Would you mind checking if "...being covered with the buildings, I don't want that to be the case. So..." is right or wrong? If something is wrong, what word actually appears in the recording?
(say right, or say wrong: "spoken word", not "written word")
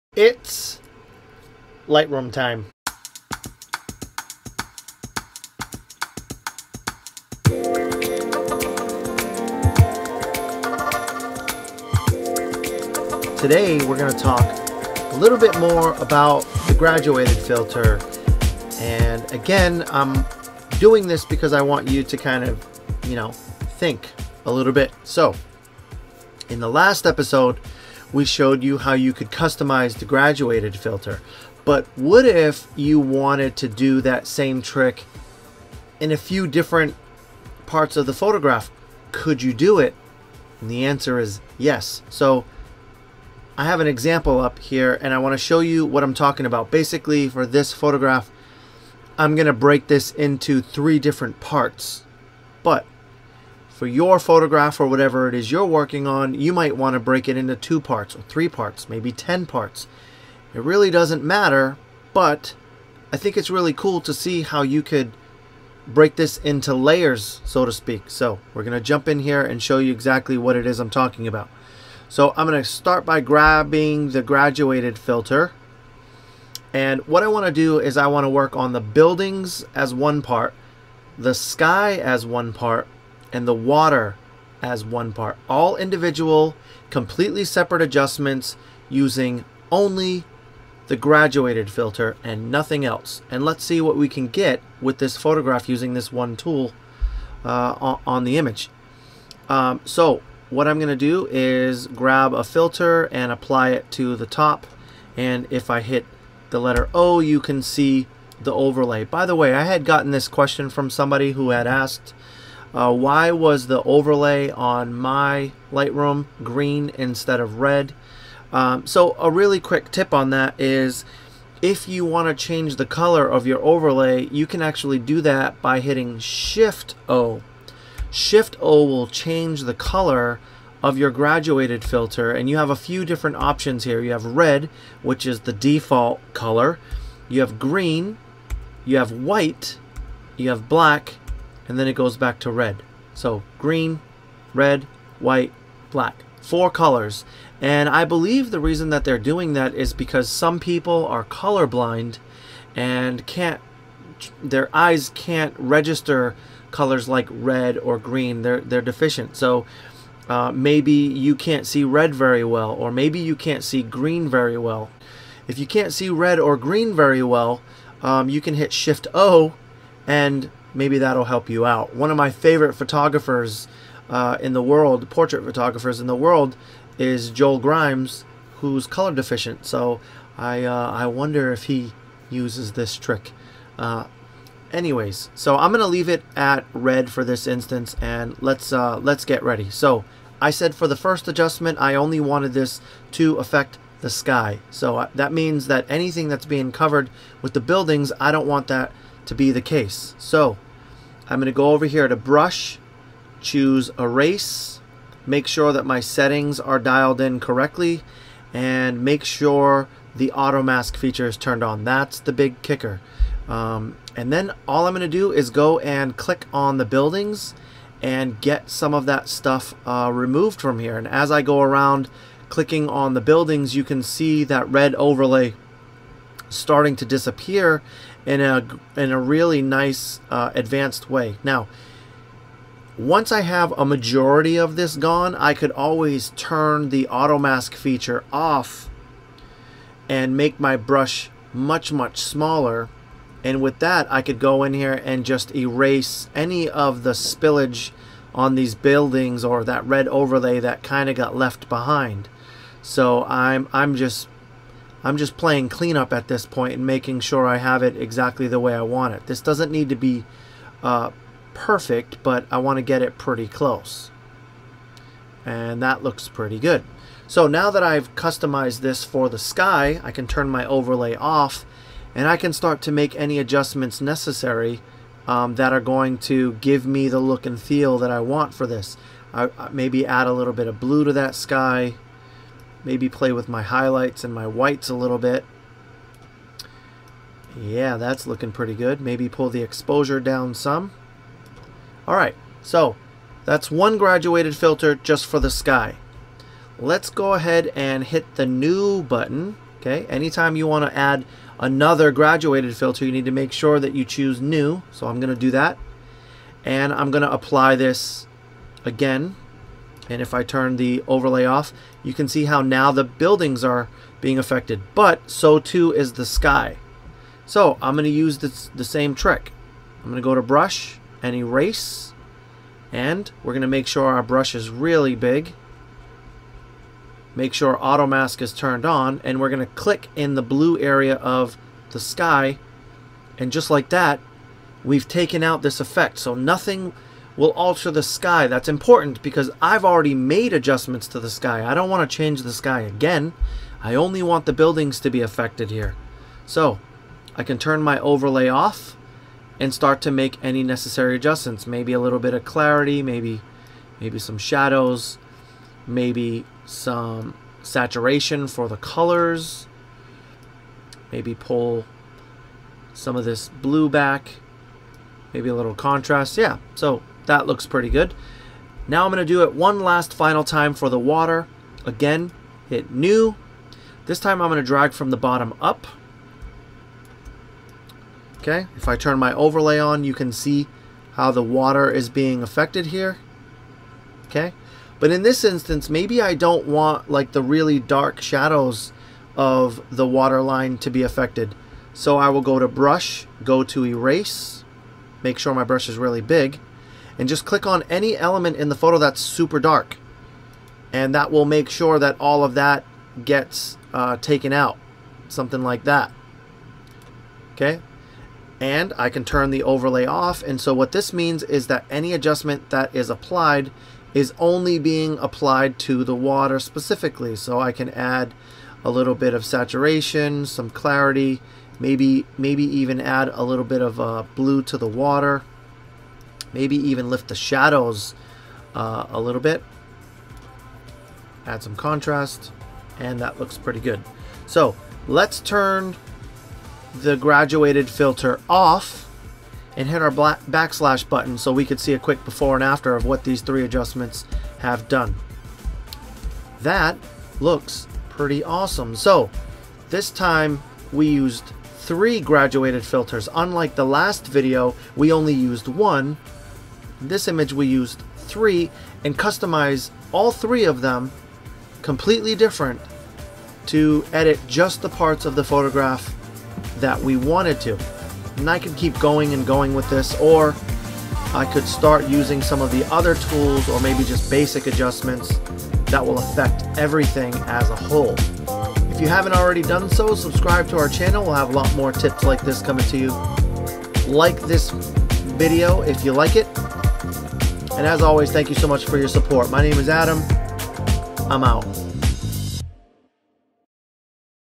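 right.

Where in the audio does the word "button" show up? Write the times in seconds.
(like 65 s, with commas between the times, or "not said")
299 s, 441 s.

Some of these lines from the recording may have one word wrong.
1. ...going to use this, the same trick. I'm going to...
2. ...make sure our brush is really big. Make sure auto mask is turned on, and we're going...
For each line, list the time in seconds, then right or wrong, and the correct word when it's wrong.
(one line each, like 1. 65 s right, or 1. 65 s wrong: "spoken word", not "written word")
1. 317 s right
2. 323 s right.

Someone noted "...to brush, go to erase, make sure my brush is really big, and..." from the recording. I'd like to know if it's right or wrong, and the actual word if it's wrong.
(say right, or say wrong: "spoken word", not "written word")
right.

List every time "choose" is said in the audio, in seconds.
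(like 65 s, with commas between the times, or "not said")
203 s, 304 s.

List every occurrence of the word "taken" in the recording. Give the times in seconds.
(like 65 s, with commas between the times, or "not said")
335 s, 404 s.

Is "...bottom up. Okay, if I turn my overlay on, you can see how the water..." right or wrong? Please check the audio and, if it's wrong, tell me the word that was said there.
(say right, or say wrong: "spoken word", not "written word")
right.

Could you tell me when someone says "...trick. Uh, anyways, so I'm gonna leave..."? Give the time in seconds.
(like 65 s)
182 s.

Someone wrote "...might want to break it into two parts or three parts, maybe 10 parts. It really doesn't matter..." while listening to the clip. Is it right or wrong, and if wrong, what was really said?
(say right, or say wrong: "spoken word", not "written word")
right.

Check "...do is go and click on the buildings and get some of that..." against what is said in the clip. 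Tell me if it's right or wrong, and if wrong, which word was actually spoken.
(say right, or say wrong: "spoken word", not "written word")
right.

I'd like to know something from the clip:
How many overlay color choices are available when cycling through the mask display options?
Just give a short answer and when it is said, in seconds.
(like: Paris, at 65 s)
4, at 146 s.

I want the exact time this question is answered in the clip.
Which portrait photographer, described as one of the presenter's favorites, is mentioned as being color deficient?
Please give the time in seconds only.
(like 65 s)
177 s.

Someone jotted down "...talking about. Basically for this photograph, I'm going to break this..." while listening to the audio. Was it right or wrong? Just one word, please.
right.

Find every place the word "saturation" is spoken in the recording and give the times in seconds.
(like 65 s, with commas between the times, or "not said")
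357 s, 419 s.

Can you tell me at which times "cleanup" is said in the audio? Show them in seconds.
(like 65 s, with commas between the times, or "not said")
255 s.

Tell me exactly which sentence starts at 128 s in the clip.
Shift O will change the color of your graduated filter and you have a few different options here.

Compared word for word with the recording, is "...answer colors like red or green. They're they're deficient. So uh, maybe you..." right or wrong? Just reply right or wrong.
wrong.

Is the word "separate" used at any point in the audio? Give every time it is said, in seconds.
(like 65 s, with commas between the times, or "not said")
87 s.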